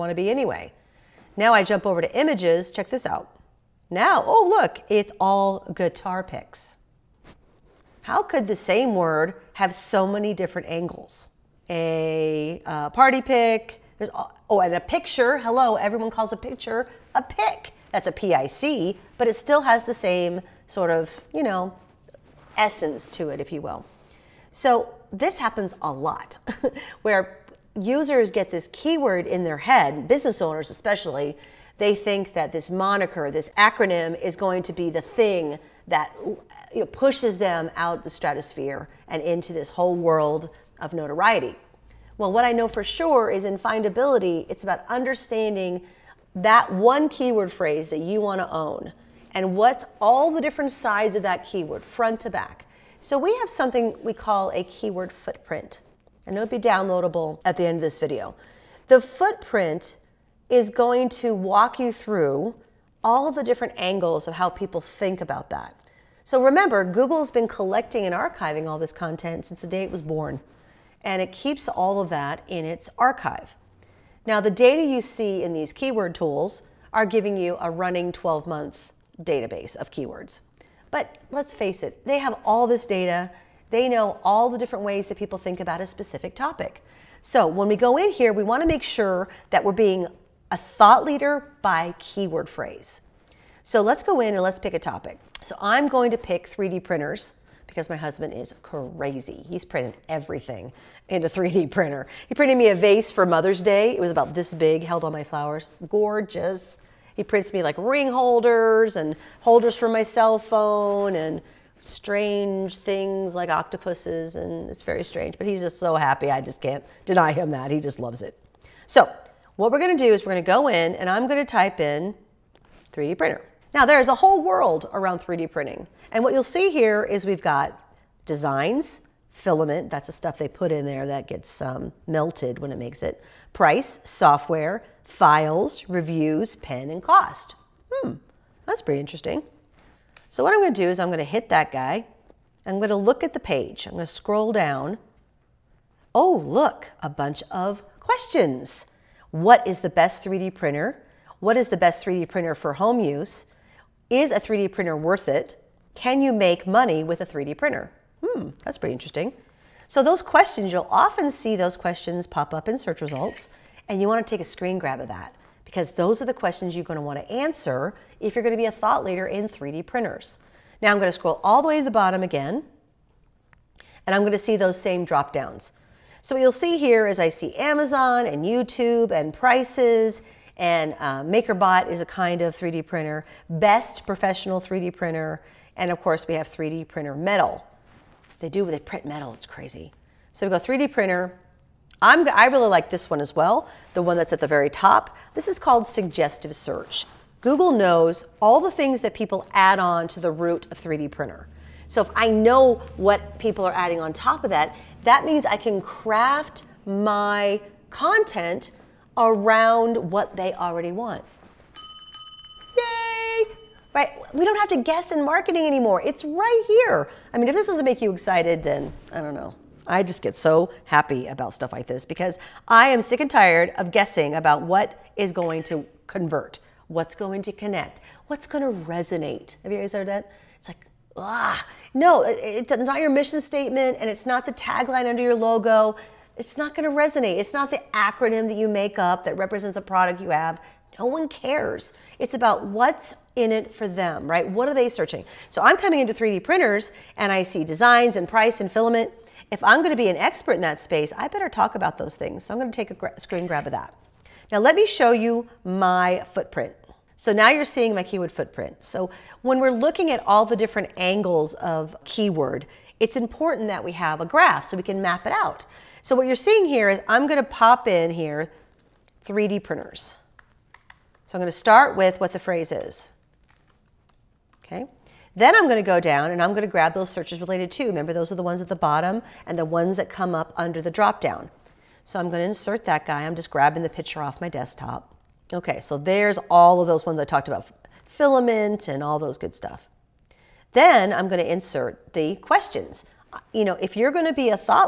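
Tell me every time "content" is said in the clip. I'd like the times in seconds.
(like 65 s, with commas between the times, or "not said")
68 s, 207 s.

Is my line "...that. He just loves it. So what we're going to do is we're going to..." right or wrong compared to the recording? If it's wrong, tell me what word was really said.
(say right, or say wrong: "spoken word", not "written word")
right.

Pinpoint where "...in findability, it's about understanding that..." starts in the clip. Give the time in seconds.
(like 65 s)
43 s.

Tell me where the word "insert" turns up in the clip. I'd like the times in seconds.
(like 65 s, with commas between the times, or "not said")
282 s, 291 s.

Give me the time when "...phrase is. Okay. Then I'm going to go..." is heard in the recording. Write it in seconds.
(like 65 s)
272 s.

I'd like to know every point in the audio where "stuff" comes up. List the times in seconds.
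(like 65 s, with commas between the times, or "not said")
130 s, 221 s, 289 s.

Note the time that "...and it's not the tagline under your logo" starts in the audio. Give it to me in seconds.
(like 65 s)
233 s.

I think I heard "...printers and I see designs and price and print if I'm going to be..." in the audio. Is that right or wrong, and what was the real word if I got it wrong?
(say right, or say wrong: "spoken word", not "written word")
wrong: "filament", not "print".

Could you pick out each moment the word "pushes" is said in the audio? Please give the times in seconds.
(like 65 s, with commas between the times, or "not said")
36 s.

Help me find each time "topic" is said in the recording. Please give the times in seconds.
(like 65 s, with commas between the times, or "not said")
86 s, 94 s.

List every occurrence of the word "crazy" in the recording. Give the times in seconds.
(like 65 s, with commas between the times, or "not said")
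98 s, 189 s.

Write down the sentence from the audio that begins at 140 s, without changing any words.
So what I'm going to do is I'm going to hit that guy.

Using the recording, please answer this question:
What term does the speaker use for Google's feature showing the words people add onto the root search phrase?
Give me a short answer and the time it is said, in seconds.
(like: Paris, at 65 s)
suggestive search, at 195 s.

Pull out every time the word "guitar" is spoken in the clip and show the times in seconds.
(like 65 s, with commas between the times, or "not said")
5 s.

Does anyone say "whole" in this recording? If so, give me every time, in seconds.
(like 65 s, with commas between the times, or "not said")
39 s, 124 s.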